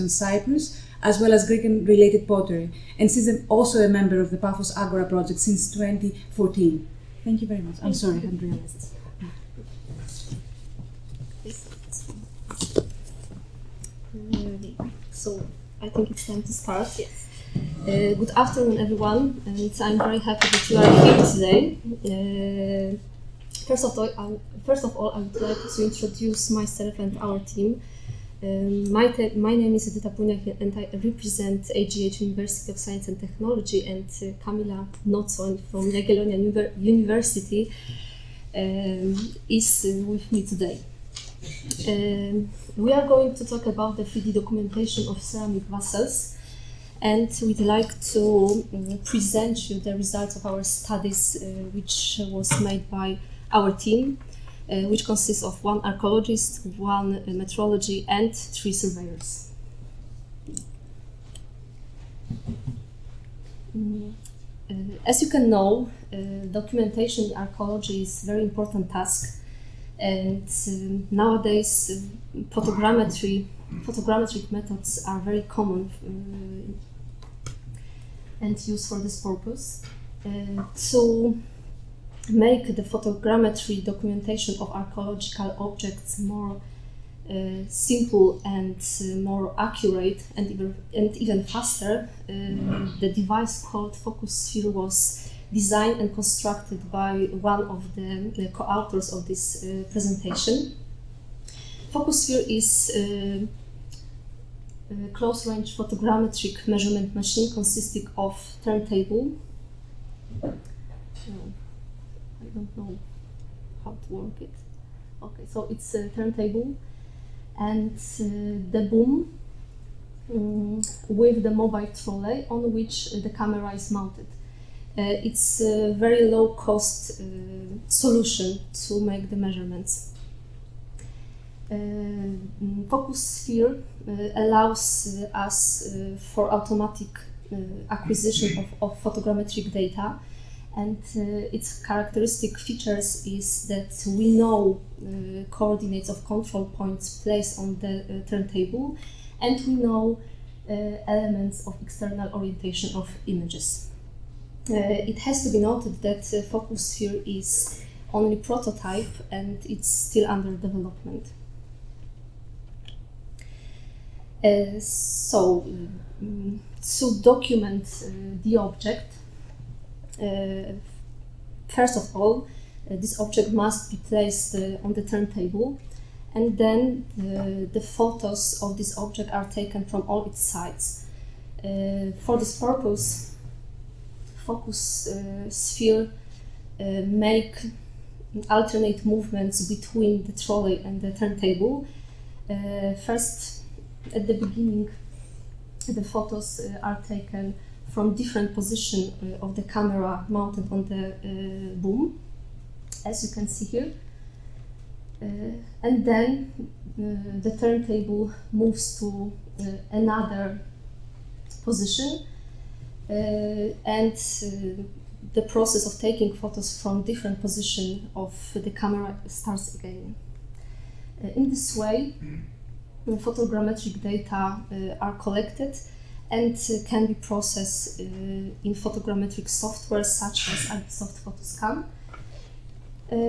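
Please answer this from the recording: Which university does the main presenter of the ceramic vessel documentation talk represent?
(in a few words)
AGH University of Science and Technology.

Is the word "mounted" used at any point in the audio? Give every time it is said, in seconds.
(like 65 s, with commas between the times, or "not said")
123 s, 200 s.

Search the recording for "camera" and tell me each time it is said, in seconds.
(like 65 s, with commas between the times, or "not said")
123 s, 199 s, 218 s.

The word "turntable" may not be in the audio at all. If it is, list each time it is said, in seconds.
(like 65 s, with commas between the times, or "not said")
108 s, 116 s, 148 s, 175 s, 191 s, 207 s.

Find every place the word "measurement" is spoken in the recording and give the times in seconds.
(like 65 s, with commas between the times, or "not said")
106 s, 129 s.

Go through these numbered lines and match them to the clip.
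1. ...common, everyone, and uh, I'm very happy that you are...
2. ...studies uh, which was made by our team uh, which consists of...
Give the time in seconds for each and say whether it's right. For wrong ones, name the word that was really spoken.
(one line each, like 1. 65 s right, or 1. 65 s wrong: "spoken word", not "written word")
1. 18 s wrong: "afternoon", not "common"
2. 50 s right.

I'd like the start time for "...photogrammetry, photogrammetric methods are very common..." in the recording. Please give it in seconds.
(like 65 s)
72 s.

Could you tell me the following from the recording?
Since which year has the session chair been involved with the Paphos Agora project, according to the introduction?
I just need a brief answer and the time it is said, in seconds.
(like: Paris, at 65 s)
2014, at 5 s.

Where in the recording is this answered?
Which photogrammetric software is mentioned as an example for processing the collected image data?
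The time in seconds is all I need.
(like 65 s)
230 s.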